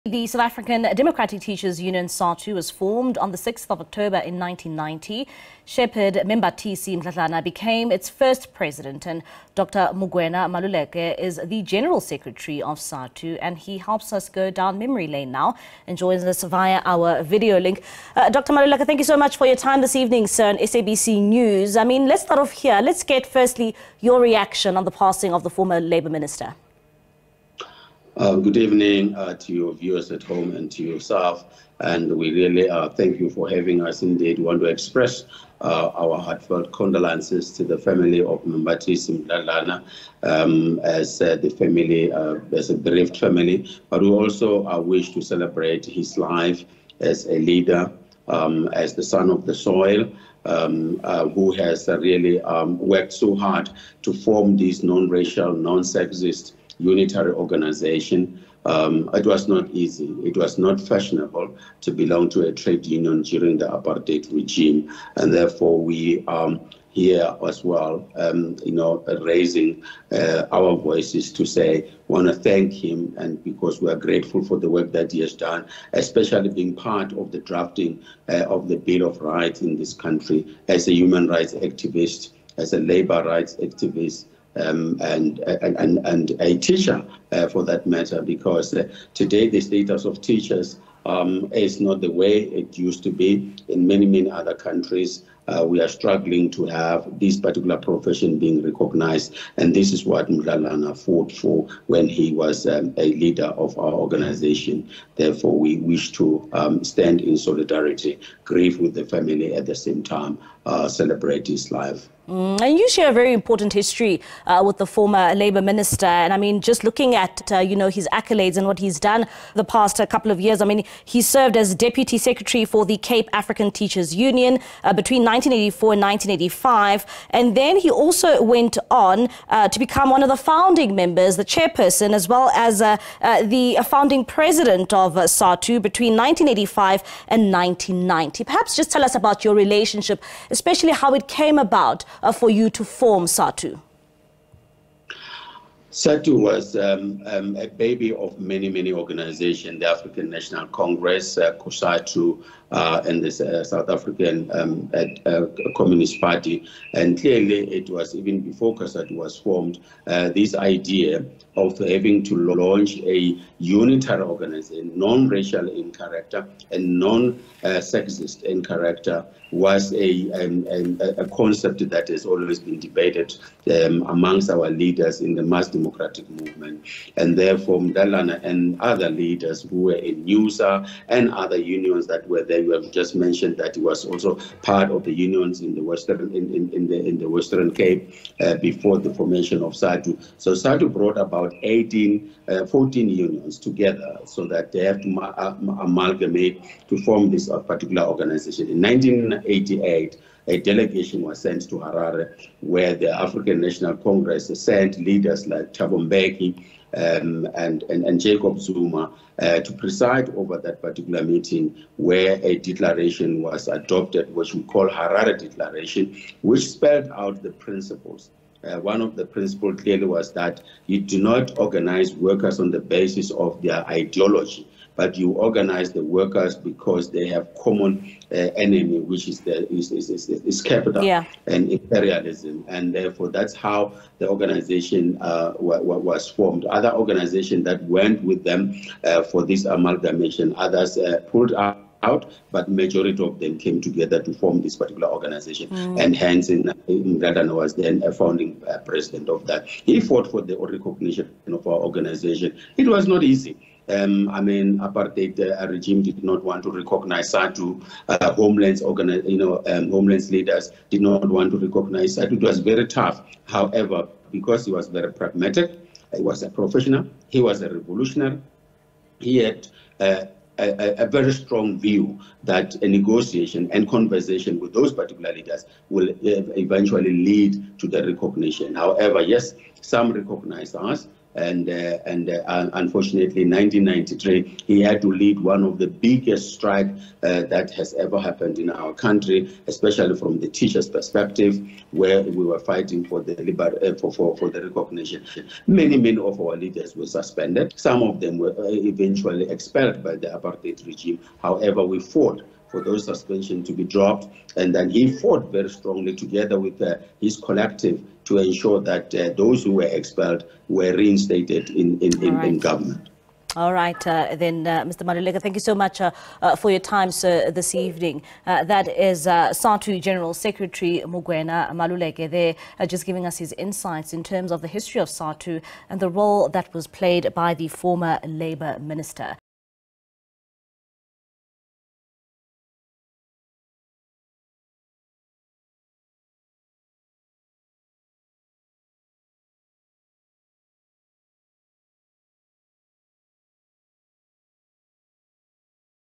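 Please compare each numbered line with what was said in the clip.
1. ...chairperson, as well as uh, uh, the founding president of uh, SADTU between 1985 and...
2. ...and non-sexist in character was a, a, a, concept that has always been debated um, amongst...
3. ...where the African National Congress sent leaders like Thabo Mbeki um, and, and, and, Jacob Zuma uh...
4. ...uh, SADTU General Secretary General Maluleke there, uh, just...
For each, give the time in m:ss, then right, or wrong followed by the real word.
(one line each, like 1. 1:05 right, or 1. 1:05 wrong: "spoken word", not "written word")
1. 2:11 right
2. 2:46 right
3. 3:22 right
4. 5:19 wrong: "Mugwena", not "General".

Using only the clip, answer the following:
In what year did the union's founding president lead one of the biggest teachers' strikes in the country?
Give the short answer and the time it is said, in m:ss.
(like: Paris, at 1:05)
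1993, at 4:43.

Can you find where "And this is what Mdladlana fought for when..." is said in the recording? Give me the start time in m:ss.
1:39.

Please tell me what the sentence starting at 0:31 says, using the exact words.
And we really uh, thank you for having us.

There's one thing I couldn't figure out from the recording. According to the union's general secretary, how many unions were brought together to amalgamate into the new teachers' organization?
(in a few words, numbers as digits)
14.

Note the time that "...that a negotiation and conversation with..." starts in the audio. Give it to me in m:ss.
4:32.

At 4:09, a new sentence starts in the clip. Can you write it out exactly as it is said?
He fought for the recognition of our organization.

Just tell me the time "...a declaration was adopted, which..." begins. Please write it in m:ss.
3:32.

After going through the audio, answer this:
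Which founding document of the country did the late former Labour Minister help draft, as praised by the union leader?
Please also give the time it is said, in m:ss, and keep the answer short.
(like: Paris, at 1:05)
Bill of Rights, at 1:18.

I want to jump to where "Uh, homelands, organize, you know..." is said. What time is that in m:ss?
4:18.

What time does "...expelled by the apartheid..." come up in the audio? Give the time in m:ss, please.
4:59.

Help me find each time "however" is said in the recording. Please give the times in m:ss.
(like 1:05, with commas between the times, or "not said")
4:23, 4:38, 5:01.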